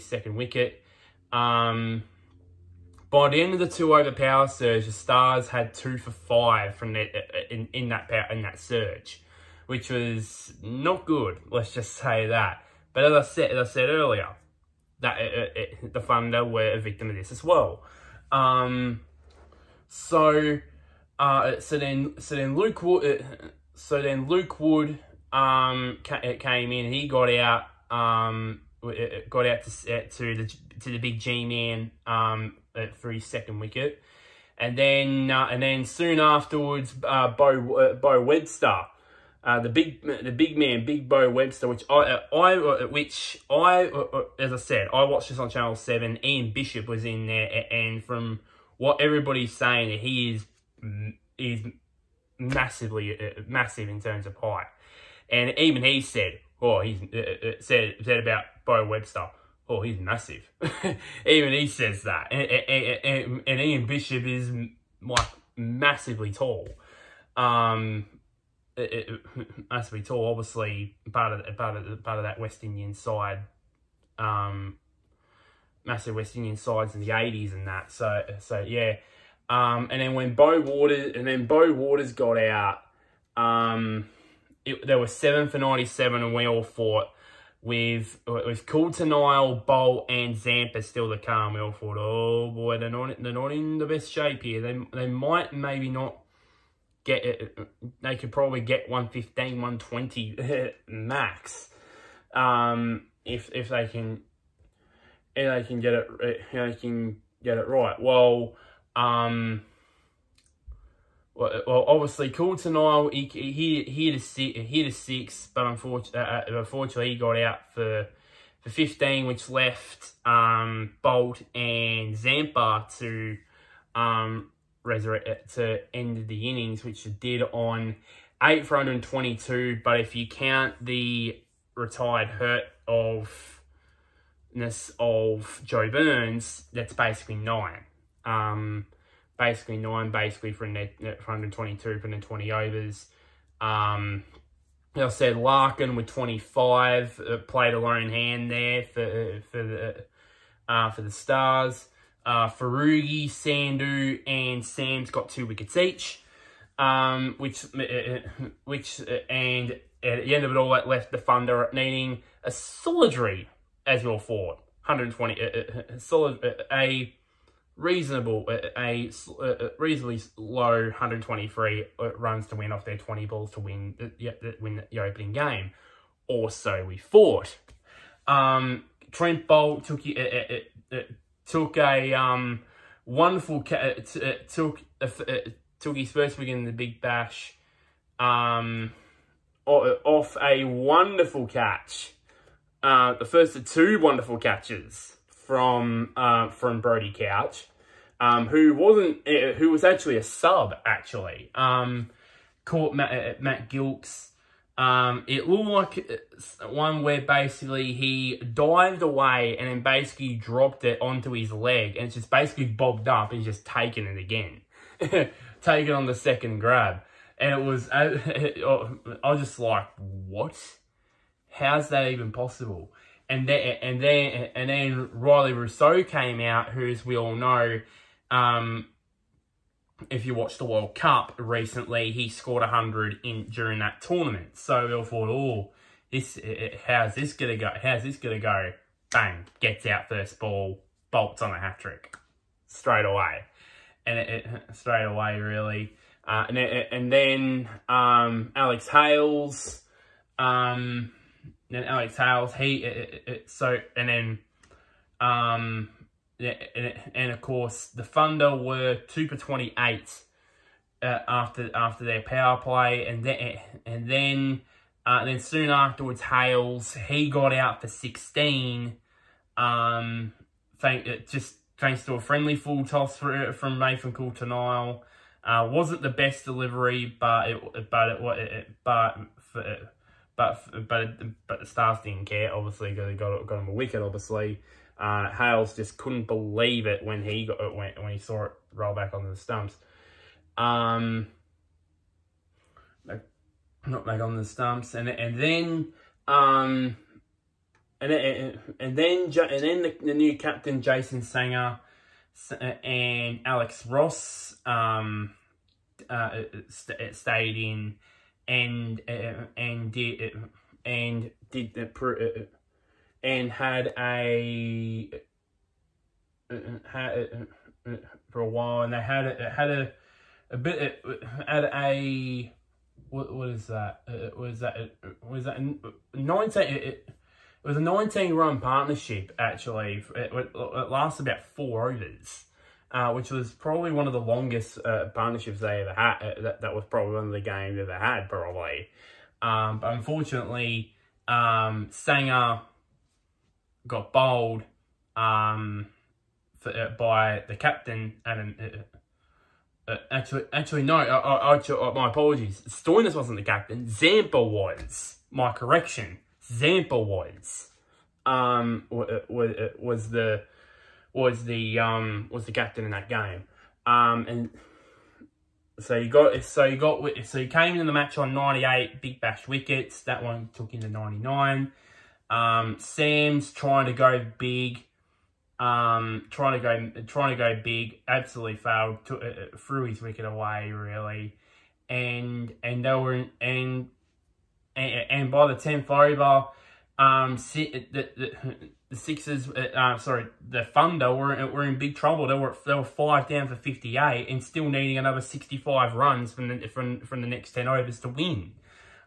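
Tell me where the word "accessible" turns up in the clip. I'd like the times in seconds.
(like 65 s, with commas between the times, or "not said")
not said.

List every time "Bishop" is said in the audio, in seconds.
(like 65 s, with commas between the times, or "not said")
46 s, 63 s.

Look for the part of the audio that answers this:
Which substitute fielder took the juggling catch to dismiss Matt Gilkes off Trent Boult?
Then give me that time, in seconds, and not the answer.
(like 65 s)
196 s.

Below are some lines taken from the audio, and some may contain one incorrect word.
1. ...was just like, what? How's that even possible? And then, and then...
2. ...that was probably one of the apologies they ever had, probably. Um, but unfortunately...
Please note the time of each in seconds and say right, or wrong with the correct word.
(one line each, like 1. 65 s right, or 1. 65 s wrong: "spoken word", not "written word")
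1. 219 s right
2. 336 s wrong: "games", not "apologies".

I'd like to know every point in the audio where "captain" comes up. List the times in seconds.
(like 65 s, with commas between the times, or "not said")
300 s, 347 s, 353 s, 362 s.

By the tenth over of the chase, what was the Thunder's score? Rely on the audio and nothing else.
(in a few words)
5 for 58.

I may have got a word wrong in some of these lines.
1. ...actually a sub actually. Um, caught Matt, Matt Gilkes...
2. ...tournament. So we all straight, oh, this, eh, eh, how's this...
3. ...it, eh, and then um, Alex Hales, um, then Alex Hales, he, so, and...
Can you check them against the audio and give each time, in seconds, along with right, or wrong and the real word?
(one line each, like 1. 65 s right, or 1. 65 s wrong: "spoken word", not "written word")
1. 199 s right
2. 234 s wrong: "thought", not "straight"
3. 246 s right.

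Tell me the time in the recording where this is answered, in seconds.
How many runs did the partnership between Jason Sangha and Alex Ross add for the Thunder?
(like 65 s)
327 s.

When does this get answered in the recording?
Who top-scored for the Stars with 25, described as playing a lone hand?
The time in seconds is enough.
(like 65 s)
145 s.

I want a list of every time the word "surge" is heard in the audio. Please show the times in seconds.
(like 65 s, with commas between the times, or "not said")
4 s, 8 s.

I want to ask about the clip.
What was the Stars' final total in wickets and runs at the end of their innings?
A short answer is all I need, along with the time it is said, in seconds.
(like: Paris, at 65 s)
8 for 122, at 128 s.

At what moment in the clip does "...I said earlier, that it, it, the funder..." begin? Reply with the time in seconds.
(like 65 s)
13 s.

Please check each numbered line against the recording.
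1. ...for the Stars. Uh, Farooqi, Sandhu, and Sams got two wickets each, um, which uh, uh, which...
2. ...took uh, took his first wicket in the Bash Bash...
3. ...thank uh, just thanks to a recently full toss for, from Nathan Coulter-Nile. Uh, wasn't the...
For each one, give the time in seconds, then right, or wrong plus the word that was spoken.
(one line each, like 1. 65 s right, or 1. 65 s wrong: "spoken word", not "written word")
1. 150 s right
2. 184 s wrong: "Big", not "Bash"
3. 270 s wrong: "friendly", not "recently".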